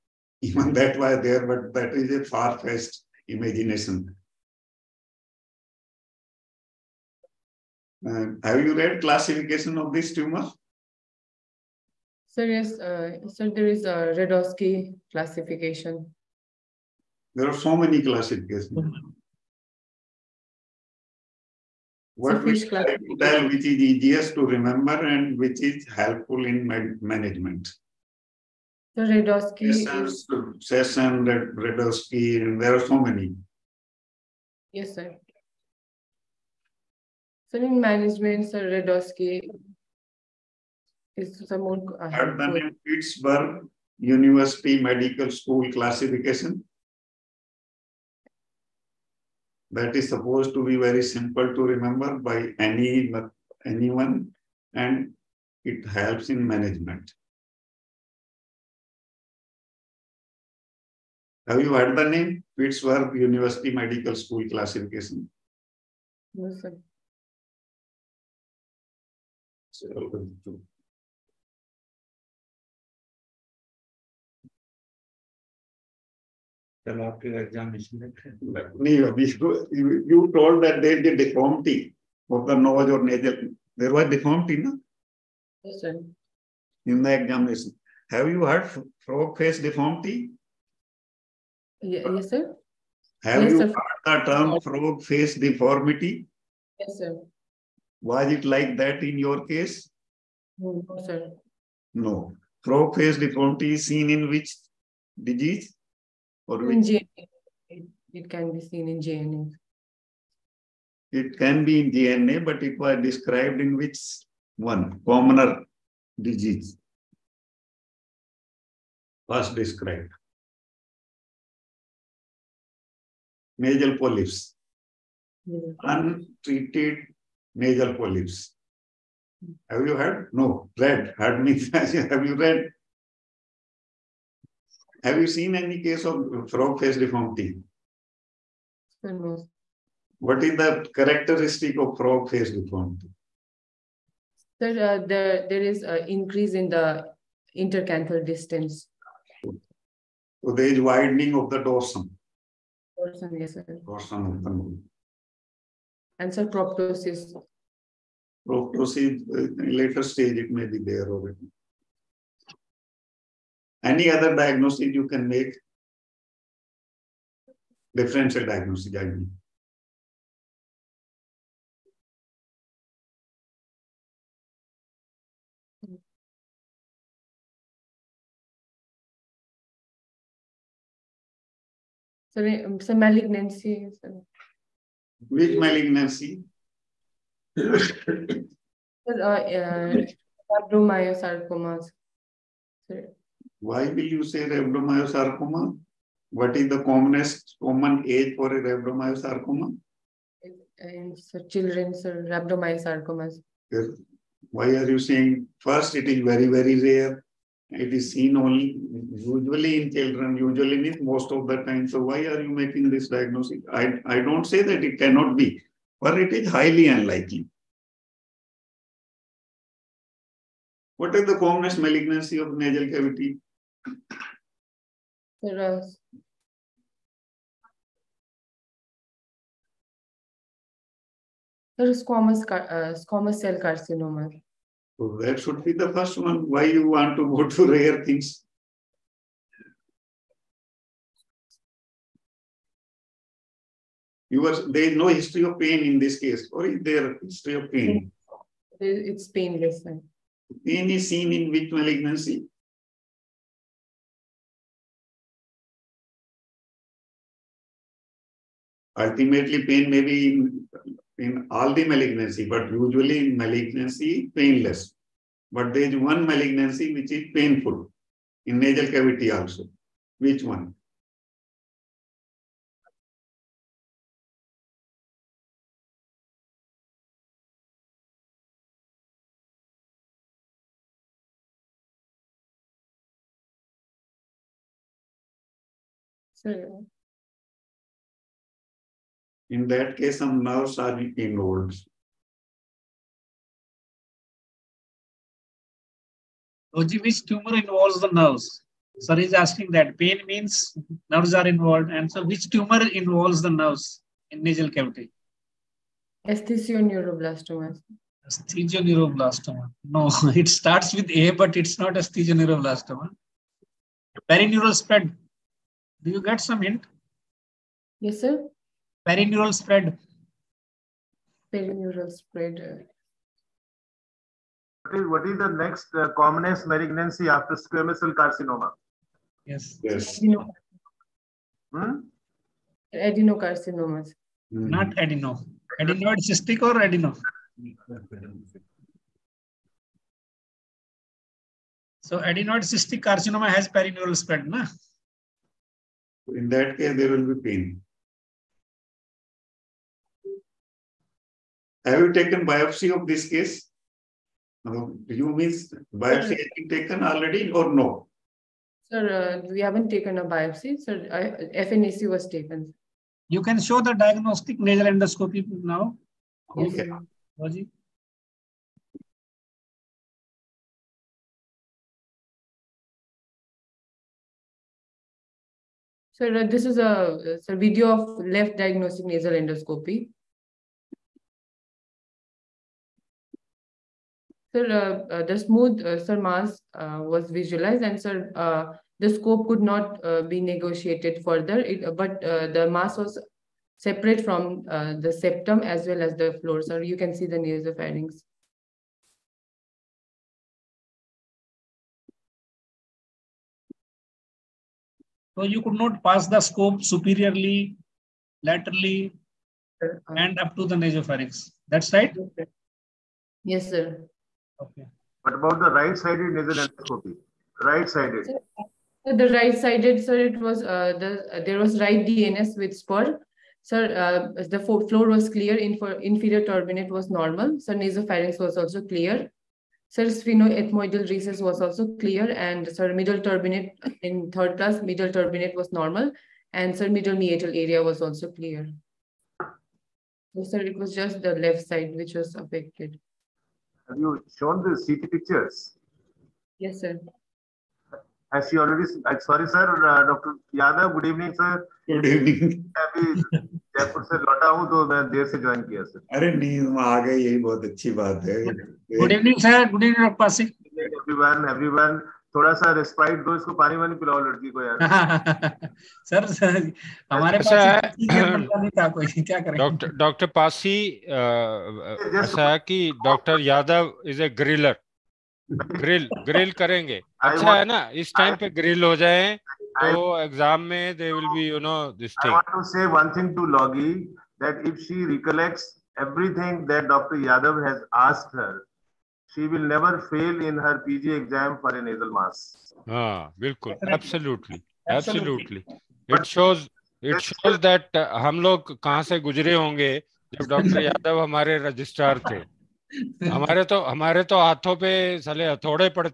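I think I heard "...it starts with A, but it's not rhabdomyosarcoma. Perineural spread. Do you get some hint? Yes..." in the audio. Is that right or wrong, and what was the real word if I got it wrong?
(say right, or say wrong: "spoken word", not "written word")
wrong: "esthesioneuroblastoma", not "rhabdomyosarcoma".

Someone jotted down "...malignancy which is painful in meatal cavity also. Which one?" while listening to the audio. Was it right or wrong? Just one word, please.
wrong.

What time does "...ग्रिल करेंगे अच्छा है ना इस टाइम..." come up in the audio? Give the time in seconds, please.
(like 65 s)
476 s.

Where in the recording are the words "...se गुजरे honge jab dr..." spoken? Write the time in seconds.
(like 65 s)
499 s.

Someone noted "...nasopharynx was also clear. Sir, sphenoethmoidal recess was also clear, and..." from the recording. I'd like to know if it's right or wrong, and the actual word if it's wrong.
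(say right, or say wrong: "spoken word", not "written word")
right.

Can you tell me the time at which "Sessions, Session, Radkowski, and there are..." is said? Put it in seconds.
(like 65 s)
29 s.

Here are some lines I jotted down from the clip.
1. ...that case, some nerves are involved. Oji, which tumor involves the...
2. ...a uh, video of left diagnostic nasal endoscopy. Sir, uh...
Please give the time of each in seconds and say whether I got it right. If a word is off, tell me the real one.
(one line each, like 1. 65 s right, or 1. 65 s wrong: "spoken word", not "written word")
1. 289 s right
2. 377 s right.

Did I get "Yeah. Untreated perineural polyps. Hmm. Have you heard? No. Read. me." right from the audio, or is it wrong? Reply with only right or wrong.
wrong.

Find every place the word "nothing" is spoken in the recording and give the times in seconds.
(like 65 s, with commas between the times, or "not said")
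not said.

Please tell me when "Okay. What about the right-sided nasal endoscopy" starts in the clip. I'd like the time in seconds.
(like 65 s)
414 s.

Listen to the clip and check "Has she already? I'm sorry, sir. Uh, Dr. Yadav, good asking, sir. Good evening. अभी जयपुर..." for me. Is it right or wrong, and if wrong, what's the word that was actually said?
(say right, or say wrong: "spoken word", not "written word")
wrong: "evening", not "asking".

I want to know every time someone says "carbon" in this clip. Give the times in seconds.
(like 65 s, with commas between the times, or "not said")
not said.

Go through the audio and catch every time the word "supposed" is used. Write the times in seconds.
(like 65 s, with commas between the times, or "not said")
50 s.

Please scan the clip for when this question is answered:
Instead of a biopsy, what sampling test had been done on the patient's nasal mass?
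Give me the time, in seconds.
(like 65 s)
361 s.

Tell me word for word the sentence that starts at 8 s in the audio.
Uh, have you read classification of this tumor?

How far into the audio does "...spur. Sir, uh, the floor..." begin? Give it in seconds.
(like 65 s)
422 s.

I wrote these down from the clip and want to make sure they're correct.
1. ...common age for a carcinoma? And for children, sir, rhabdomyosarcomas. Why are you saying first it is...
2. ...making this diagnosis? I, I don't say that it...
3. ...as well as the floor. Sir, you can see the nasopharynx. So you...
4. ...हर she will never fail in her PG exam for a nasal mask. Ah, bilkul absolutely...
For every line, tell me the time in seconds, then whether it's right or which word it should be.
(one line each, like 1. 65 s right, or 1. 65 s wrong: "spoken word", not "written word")
1. 197 s wrong: "rhabdomyosarcoma", not "carcinoma"
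2. 212 s right
3. 395 s right
4. 488 s right.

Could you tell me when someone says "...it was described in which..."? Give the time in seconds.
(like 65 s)
112 s.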